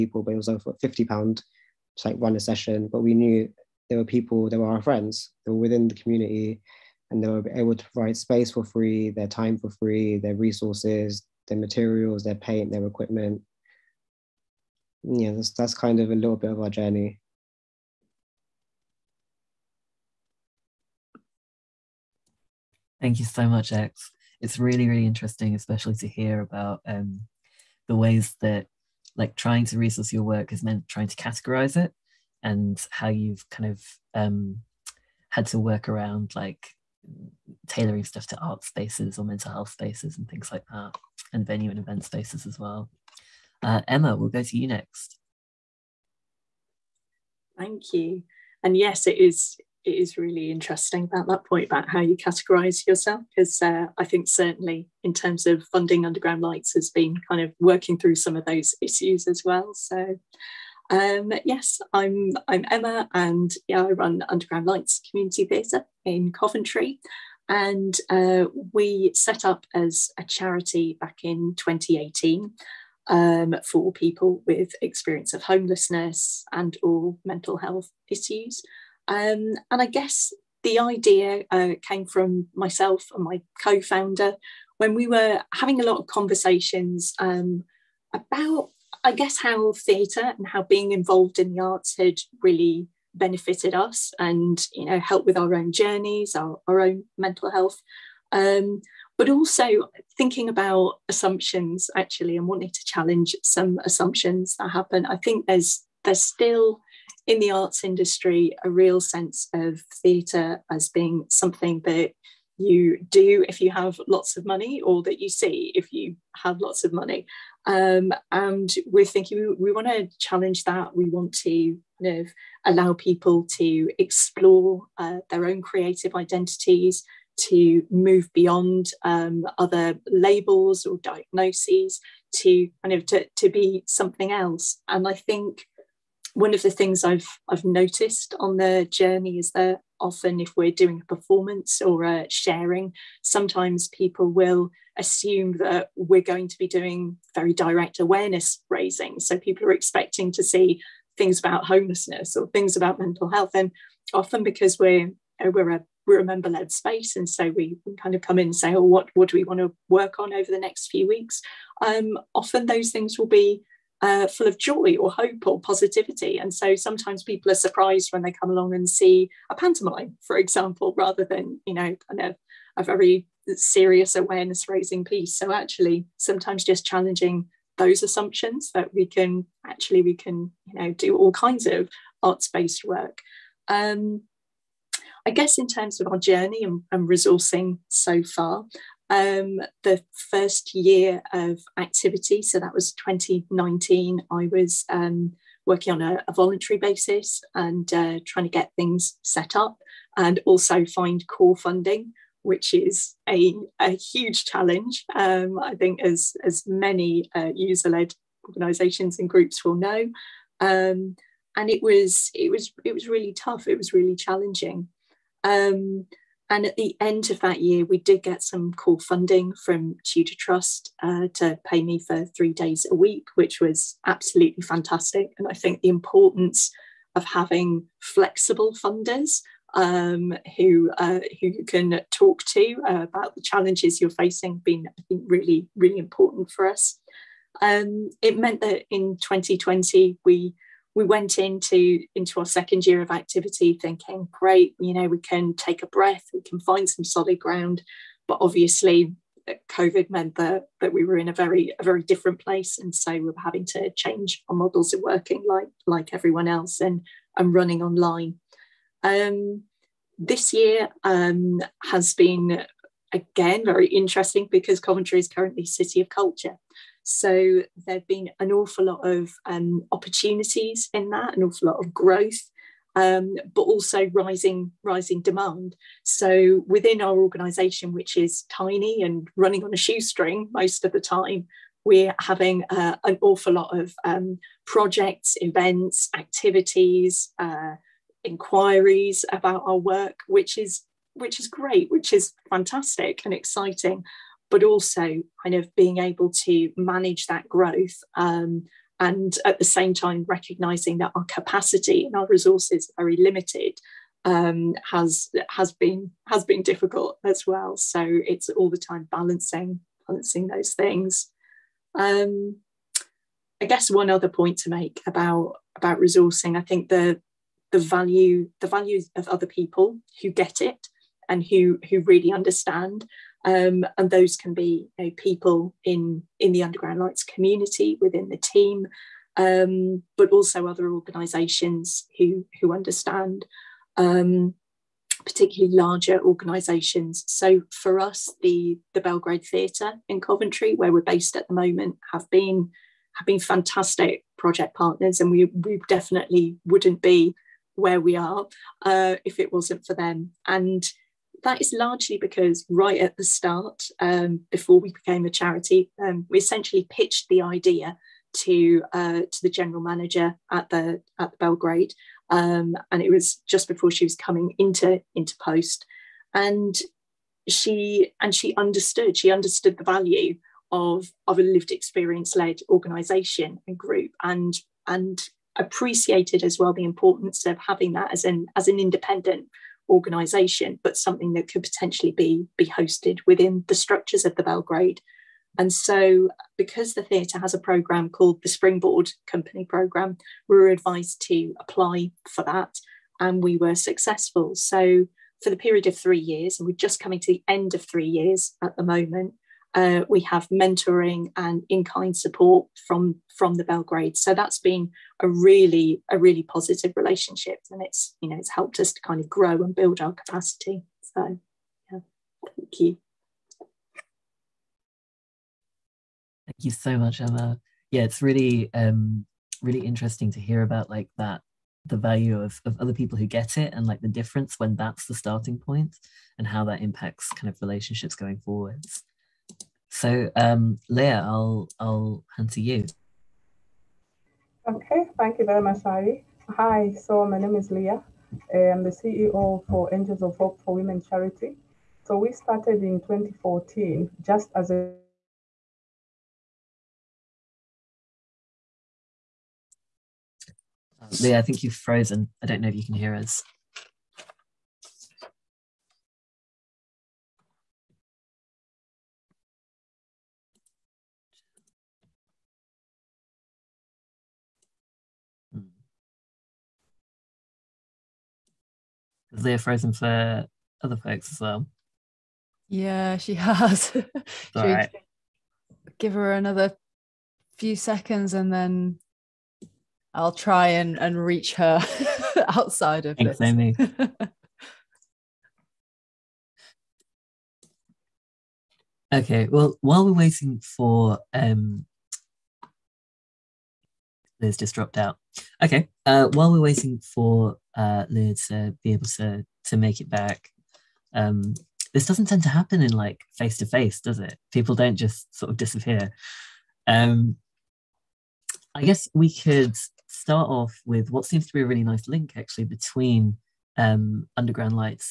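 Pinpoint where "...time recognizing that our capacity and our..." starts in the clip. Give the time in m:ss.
4:59.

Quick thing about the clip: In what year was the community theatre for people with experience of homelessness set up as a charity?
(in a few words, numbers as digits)
2018.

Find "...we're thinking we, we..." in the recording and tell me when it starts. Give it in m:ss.
1:58.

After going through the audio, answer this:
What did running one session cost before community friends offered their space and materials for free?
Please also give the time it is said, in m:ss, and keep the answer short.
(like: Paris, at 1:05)
over 50 pounds, at 0:00.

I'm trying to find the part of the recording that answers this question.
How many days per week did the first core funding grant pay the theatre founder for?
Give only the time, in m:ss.
3:42.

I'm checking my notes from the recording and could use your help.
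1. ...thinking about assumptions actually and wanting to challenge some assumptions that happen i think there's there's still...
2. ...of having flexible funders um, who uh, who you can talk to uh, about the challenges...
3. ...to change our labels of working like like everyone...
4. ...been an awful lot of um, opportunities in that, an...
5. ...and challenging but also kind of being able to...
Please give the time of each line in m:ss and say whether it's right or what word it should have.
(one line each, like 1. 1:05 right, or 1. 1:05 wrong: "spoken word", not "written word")
1. 1:40 right
2. 3:47 right
3. 4:13 wrong: "models", not "labels"
4. 4:28 right
5. 4:53 wrong: "exciting", not "challenging".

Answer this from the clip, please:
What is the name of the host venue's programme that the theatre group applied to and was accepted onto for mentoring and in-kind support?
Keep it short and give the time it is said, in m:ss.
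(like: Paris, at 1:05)
Springboard Company Programme, at 6:28.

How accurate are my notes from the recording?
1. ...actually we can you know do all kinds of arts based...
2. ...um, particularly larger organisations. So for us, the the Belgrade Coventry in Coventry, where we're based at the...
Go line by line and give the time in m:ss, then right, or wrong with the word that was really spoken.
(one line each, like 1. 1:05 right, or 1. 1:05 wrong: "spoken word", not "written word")
1. 2:59 right
2. 5:33 wrong: "Theatre", not "Coventry".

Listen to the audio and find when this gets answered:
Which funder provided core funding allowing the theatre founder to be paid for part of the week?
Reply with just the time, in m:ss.
3:40.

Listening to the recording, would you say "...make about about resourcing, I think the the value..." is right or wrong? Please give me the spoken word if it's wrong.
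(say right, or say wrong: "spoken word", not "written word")
right.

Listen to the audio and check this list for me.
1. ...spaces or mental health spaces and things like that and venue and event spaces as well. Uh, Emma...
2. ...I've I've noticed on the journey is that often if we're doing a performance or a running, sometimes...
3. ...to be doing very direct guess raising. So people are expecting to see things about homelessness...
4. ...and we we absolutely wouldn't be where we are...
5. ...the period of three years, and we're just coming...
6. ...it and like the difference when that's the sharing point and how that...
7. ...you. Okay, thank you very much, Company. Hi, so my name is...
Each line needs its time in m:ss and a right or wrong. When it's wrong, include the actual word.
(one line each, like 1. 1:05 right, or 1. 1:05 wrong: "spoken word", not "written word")
1. 0:38 right
2. 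2:17 wrong: "sharing", not "running"
3. 2:26 wrong: "awareness", not "guess"
4. 5:45 wrong: "definitely", not "absolutely"
5. 6:35 right
6. 7:03 wrong: "starting", not "sharing"
7. 7:12 wrong: "Ari", not "Company".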